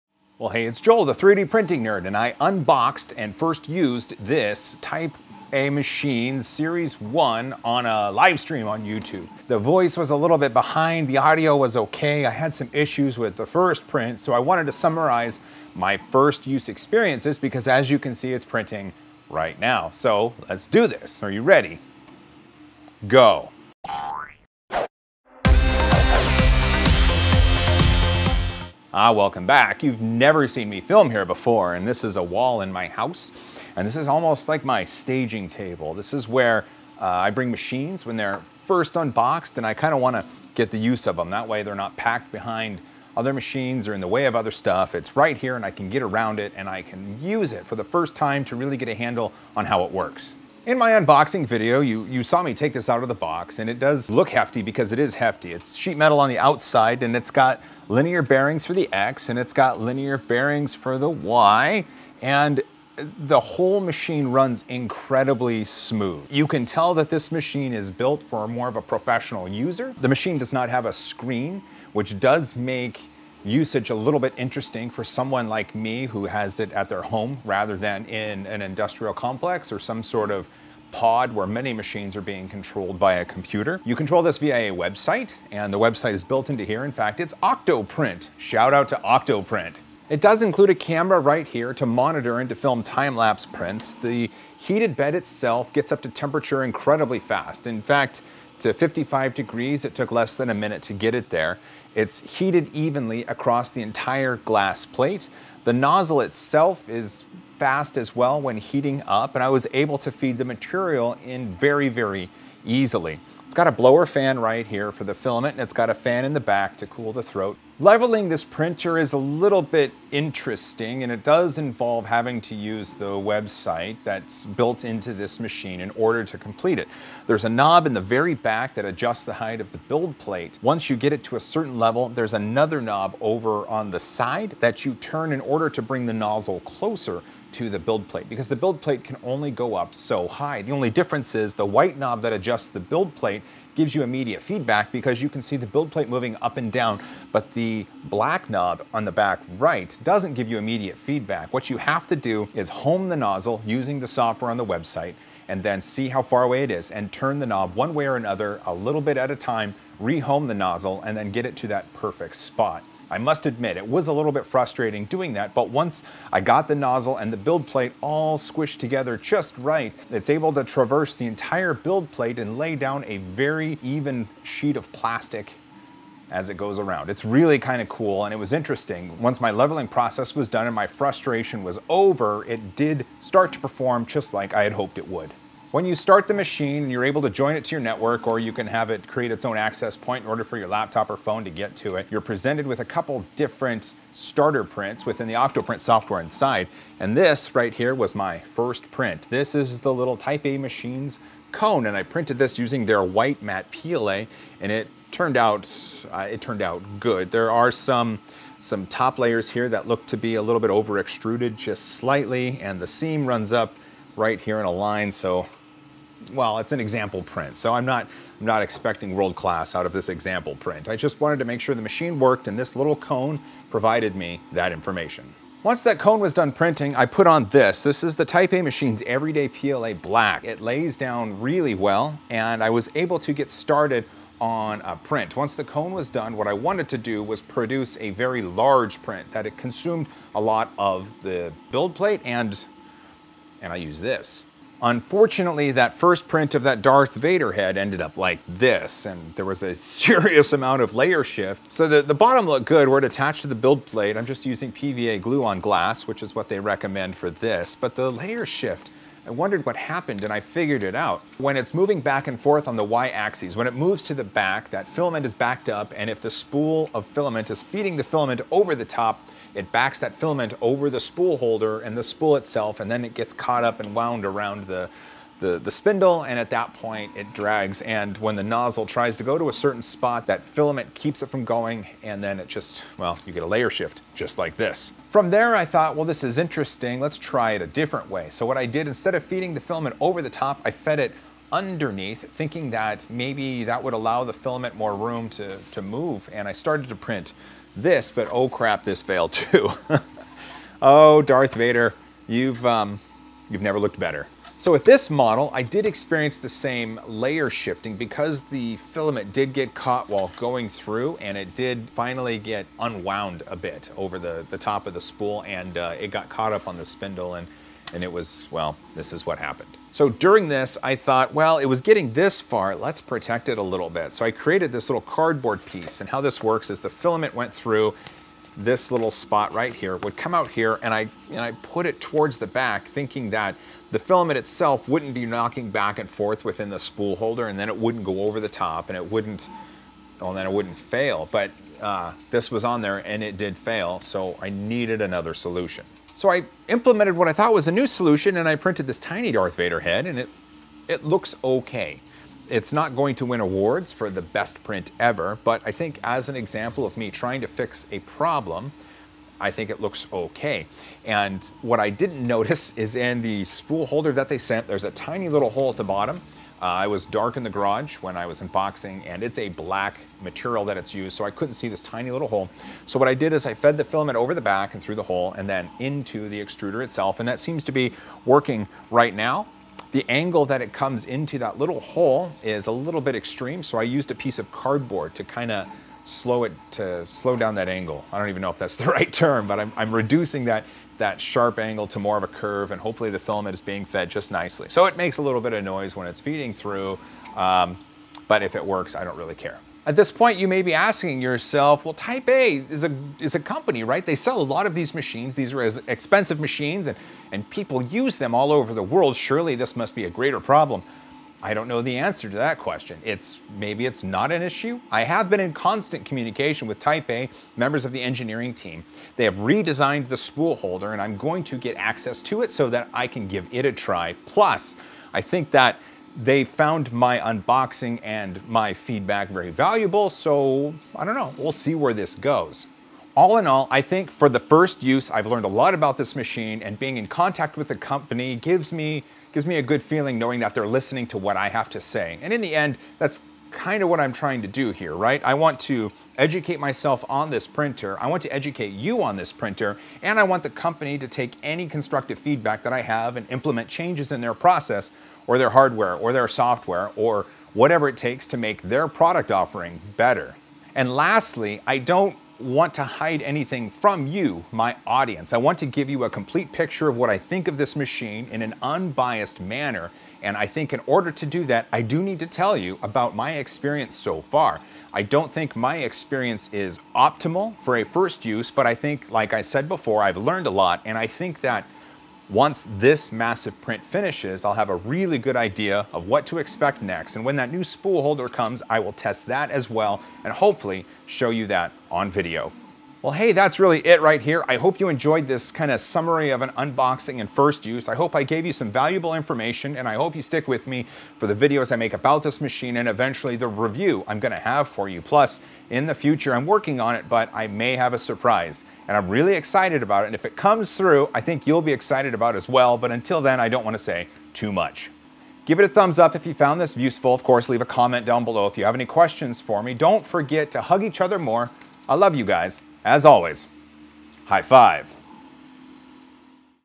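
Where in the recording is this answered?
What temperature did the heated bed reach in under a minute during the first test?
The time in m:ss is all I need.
1:38.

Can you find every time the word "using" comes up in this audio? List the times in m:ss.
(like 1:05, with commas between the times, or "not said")
2:33, 3:22, 4:14.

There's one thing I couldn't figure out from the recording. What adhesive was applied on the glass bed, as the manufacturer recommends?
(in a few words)
PVA glue.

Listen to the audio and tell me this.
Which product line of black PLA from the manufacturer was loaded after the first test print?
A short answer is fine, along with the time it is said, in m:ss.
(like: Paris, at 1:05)
Everyday PLA, at 3:49.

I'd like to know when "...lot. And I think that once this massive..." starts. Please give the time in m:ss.
8:00.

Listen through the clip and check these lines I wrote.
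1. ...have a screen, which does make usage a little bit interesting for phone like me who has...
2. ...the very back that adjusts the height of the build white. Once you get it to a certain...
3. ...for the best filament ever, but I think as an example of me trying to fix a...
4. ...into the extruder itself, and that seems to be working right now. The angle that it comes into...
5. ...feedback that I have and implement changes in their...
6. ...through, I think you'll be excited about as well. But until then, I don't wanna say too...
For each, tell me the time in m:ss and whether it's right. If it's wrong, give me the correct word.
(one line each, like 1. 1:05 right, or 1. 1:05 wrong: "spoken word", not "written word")
1. 1:10 wrong: "someone", not "phone"
2. 2:07 wrong: "plate", not "white"
3. 5:53 wrong: "print", not "filament"
4. 6:15 right
5. 7:32 right
6. 8:30 right.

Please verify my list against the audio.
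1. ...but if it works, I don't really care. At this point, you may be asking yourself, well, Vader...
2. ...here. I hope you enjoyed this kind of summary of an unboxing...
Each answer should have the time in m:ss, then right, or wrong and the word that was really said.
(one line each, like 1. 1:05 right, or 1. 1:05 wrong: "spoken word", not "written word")
1. 6:38 wrong: "Type", not "Vader"
2. 8:14 right.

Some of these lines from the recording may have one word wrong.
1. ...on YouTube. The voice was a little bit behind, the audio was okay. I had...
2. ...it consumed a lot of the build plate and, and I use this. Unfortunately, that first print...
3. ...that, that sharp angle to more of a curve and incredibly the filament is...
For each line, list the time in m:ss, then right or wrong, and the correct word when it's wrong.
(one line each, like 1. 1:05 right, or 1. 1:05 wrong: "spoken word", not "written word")
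1. 0:08 right
2. 3:59 right
3. 6:30 wrong: "hopefully", not "incredibly".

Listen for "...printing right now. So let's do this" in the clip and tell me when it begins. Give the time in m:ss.
0:18.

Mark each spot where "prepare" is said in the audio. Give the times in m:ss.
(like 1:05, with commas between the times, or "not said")
not said.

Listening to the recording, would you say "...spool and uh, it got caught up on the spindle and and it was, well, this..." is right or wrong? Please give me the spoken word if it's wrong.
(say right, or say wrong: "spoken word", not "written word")
right.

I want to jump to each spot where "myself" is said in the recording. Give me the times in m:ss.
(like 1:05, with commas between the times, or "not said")
7:26.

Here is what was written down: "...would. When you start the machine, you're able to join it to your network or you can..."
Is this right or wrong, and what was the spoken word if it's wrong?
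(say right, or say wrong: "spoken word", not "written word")
right.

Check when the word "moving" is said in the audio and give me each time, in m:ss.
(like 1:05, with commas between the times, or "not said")
2:26, 4:21.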